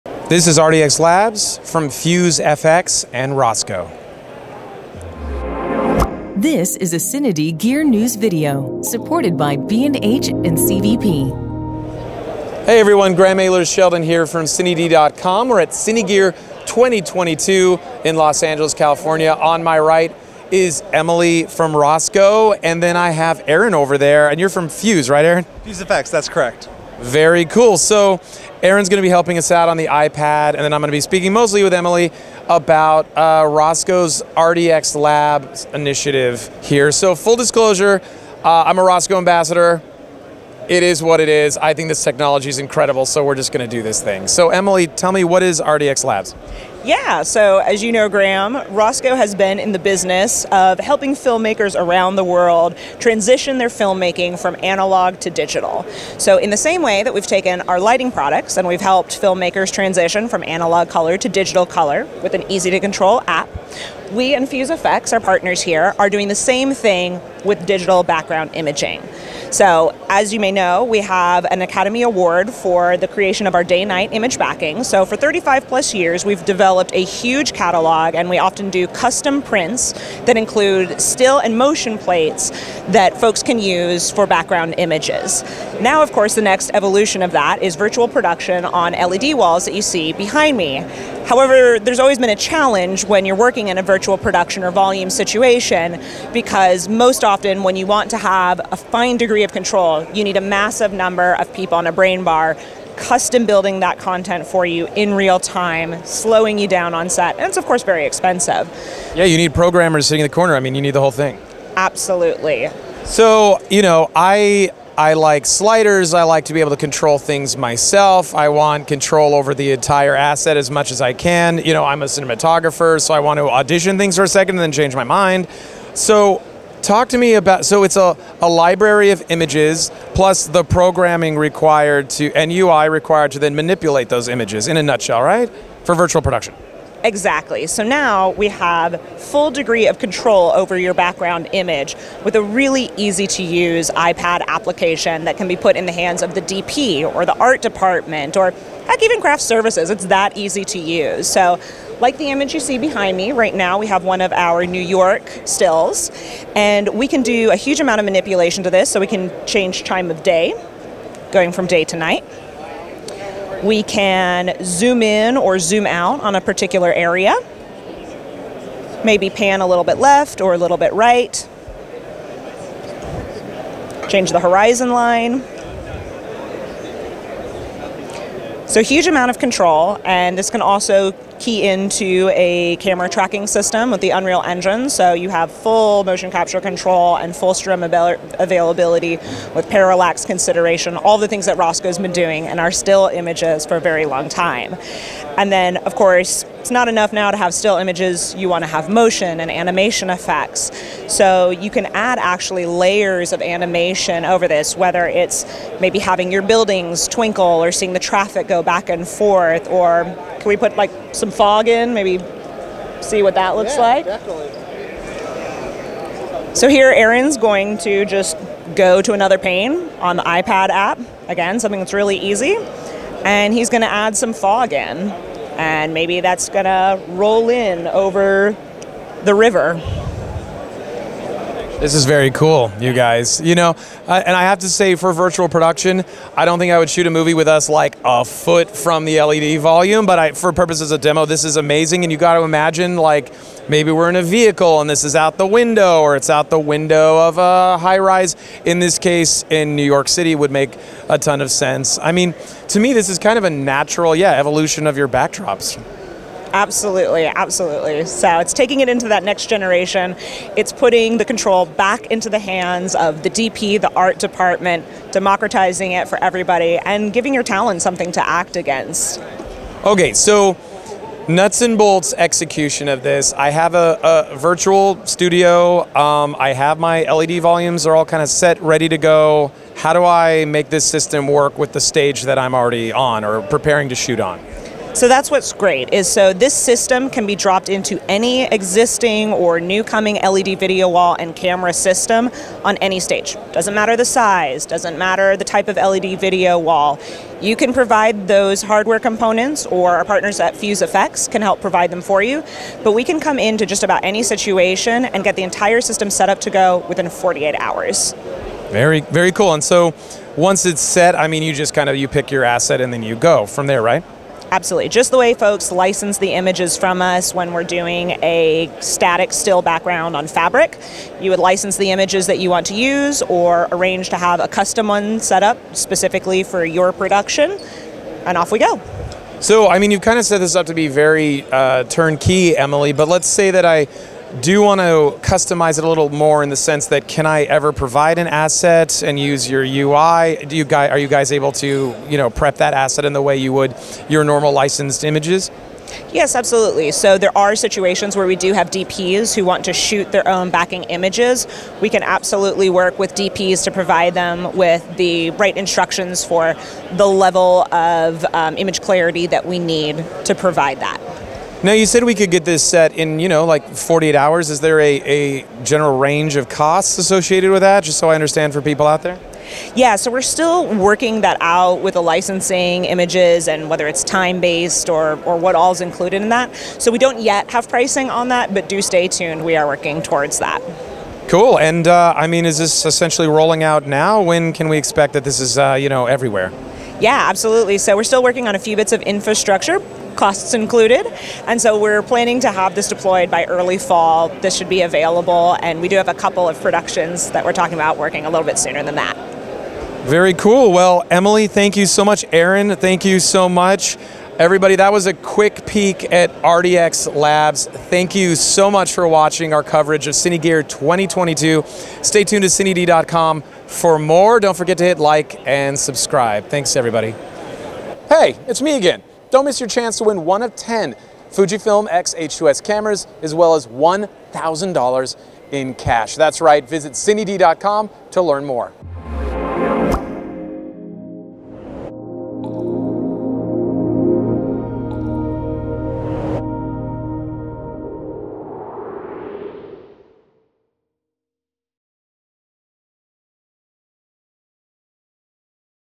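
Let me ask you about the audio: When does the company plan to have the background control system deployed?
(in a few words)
Early fall.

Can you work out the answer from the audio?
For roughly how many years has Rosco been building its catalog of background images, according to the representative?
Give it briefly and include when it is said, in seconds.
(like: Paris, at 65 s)
35, at 75 s.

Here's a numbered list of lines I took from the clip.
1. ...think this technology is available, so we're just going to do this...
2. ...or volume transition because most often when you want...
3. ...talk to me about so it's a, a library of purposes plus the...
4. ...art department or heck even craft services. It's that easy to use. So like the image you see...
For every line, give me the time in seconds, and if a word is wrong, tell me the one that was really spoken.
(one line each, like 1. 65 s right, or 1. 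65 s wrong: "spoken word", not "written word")
1. 41 s wrong: "incredible", not "available"
2. 94 s wrong: "situation", not "transition"
3. 126 s wrong: "images", not "purposes"
4. 147 s right.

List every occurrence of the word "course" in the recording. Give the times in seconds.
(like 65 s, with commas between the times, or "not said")
86 s, 107 s, 195 s.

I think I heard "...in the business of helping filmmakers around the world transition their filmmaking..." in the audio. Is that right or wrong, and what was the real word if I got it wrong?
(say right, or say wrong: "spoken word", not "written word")
right.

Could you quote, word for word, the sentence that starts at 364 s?
Is there a, a general range of costs associated with that, just so I understand for people out there?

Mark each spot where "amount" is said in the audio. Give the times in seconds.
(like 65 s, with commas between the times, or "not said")
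157 s, 179 s.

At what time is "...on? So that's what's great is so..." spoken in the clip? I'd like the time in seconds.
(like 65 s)
284 s.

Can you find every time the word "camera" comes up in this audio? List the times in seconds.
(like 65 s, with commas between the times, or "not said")
182 s, 291 s, 422 s.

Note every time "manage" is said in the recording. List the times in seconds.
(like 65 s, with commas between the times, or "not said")
not said.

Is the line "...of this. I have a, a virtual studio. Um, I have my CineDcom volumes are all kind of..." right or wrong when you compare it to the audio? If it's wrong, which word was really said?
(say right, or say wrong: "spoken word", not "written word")
wrong: "LED", not "CineDcom".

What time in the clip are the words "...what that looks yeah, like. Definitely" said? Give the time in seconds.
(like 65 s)
213 s.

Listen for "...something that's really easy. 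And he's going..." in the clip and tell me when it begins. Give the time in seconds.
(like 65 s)
221 s.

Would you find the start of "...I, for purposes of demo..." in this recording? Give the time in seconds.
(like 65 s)
240 s.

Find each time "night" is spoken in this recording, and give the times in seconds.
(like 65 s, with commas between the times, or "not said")
73 s, 161 s.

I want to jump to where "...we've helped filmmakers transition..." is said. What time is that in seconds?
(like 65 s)
58 s.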